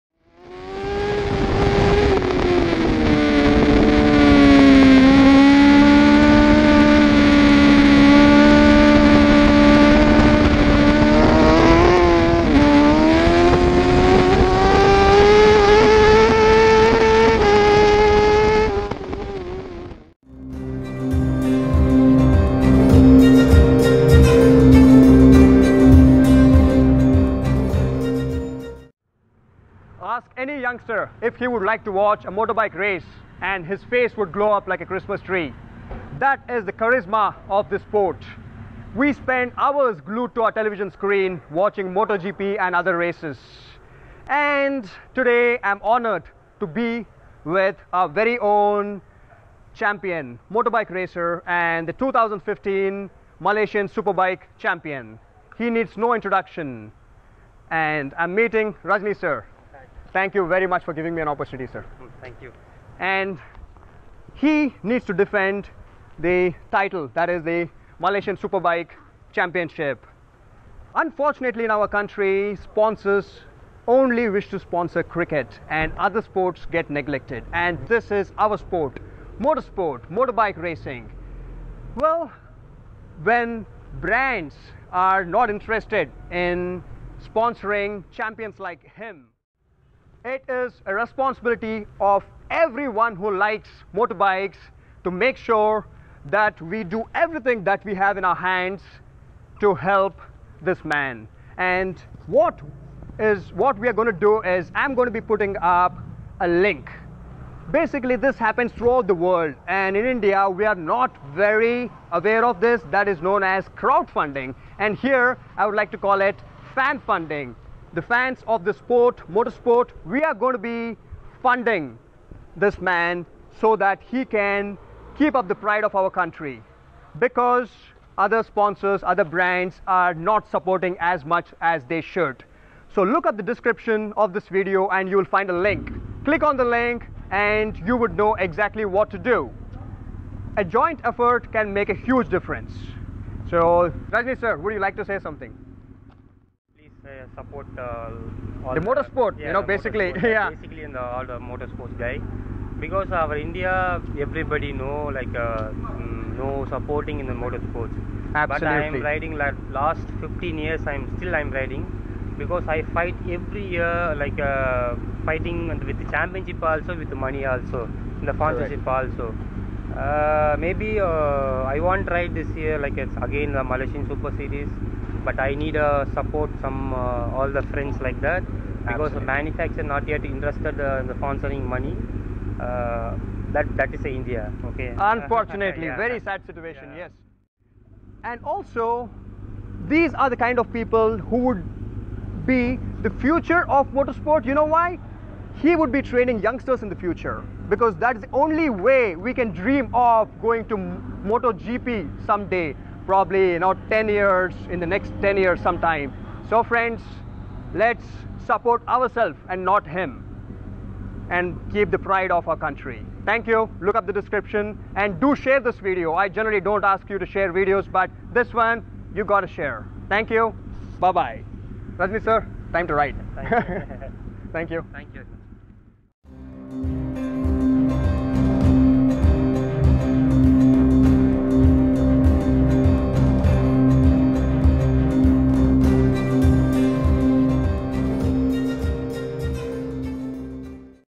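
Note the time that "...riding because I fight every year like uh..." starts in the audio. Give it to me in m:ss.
2:41.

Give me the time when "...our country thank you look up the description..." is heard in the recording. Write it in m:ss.
3:32.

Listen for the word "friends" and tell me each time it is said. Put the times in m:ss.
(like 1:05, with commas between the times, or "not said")
2:57, 3:26.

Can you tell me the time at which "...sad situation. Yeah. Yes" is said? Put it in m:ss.
3:06.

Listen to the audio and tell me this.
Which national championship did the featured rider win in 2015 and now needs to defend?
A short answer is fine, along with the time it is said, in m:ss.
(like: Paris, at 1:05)
Malaysian Superbike Championship, at 1:07.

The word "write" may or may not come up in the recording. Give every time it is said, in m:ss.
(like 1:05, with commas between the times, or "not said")
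3:42.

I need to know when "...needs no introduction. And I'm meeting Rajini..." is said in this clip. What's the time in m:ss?
0:55.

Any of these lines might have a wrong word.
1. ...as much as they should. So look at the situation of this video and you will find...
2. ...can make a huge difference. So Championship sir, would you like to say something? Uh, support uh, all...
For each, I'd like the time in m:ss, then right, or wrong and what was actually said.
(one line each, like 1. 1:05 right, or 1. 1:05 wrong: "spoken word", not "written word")
1. 2:10 wrong: "description", not "situation"
2. 2:21 wrong: "Rajini", not "Championship".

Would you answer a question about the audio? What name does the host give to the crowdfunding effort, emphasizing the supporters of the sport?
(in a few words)
fan funding.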